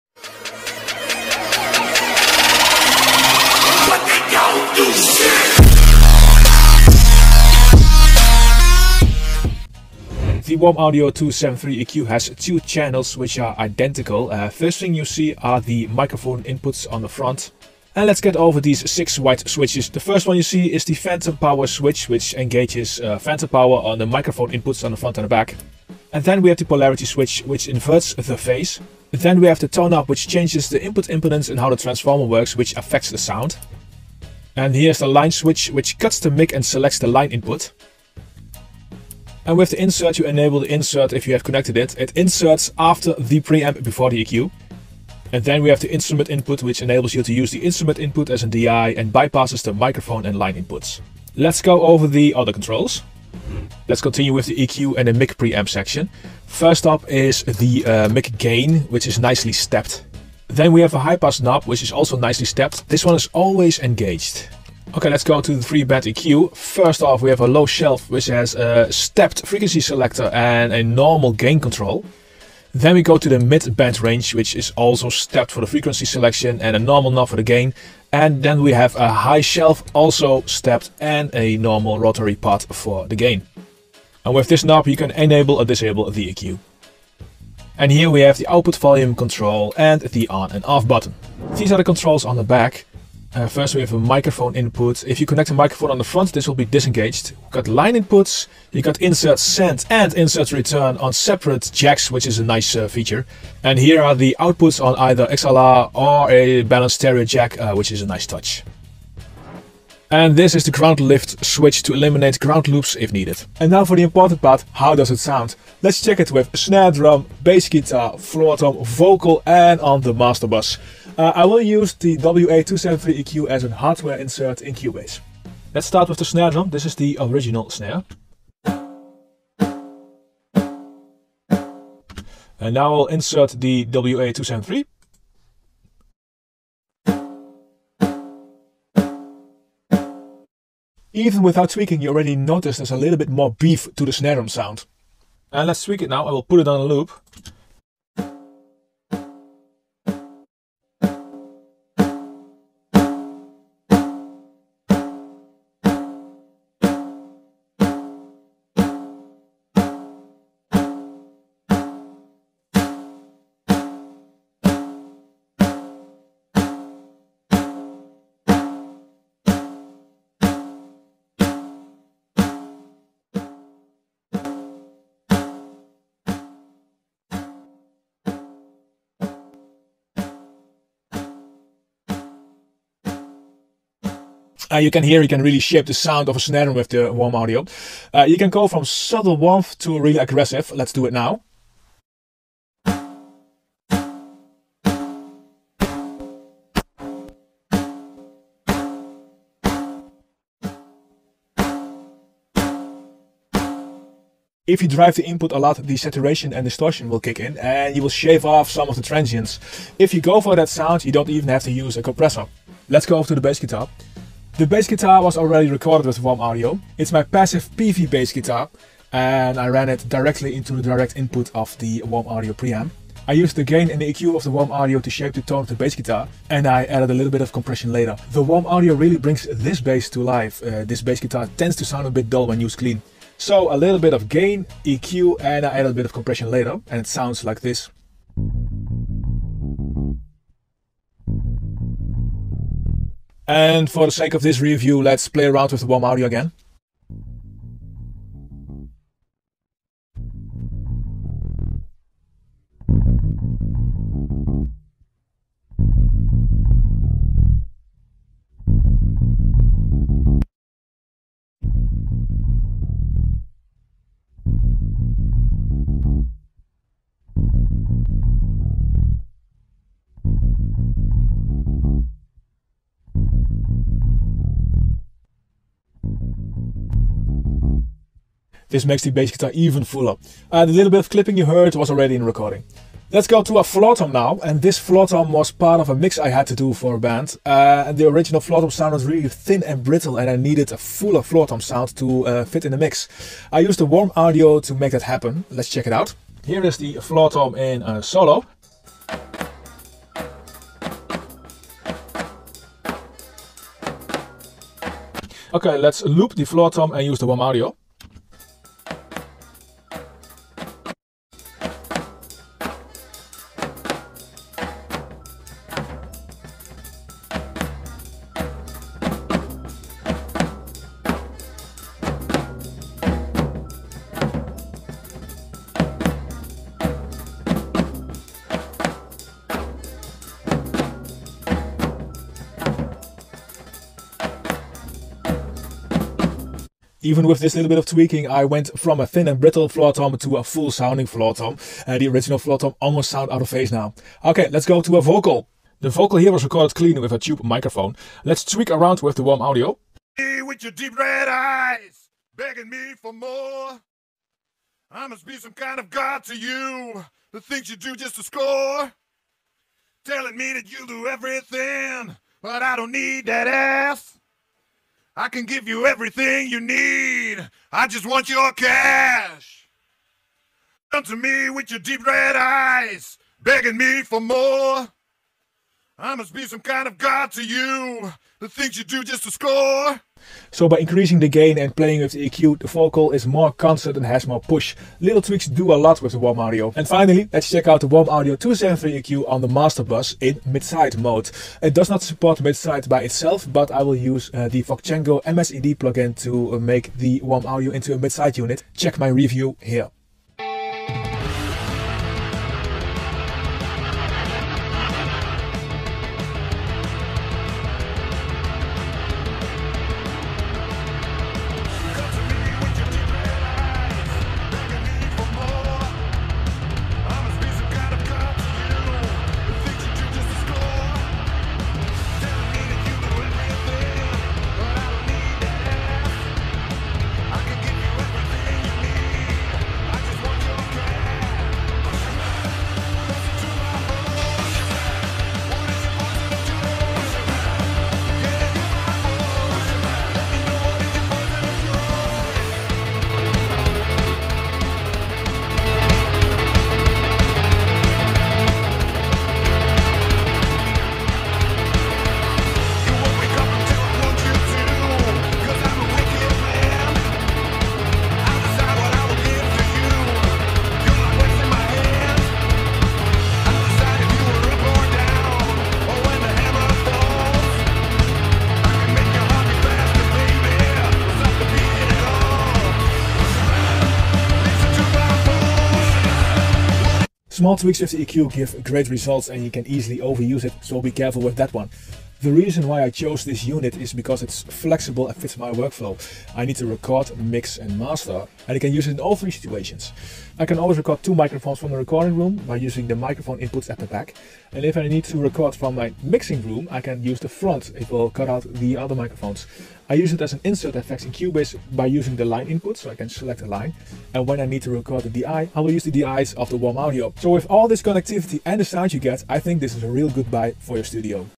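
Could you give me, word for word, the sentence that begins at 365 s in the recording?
I can give you everything you need.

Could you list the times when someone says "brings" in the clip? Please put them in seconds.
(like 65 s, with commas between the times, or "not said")
229 s.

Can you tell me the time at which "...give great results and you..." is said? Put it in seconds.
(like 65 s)
478 s.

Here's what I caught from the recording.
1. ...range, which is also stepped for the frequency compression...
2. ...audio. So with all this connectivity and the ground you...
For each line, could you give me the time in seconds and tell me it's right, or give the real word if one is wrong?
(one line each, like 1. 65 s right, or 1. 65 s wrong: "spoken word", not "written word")
1. 74 s wrong: "selection", not "compression"
2. 506 s wrong: "sound", not "ground".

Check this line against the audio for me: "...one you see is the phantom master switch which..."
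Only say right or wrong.
wrong.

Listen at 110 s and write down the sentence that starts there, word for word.
And this is the ground lift switch to eliminate ground loops if needed.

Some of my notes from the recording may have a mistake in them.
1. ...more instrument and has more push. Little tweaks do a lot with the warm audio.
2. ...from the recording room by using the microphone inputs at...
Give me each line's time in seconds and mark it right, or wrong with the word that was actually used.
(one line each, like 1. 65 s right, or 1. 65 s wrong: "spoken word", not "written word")
1. 383 s wrong: "constant", not "instrument"
2. 491 s right.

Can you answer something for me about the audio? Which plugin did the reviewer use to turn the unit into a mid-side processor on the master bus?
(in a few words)
Voxengo MSED.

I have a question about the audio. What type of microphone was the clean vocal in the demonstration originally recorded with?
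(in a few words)
Tube microphone.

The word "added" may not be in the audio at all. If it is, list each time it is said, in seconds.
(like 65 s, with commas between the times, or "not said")
226 s, 235 s.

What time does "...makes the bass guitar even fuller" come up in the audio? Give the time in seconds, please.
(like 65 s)
278 s.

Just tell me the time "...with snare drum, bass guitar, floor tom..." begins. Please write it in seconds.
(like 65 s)
116 s.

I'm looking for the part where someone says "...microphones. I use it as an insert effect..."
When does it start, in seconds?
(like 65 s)
498 s.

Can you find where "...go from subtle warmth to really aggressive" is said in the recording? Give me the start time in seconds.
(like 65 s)
188 s.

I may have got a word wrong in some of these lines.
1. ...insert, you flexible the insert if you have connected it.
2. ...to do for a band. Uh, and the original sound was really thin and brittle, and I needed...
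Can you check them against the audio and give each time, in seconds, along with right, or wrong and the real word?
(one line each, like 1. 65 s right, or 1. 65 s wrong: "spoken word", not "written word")
1. 39 s wrong: "enable", not "flexible"
2. 286 s right.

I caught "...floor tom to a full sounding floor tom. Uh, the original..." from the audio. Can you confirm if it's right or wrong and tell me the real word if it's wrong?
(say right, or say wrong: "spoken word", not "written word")
right.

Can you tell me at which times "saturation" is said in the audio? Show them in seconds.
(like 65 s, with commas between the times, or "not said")
205 s.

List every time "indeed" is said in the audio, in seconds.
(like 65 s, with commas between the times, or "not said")
not said.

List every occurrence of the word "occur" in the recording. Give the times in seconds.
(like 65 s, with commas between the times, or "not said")
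not said.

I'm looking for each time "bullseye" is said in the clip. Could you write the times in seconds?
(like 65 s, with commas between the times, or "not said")
not said.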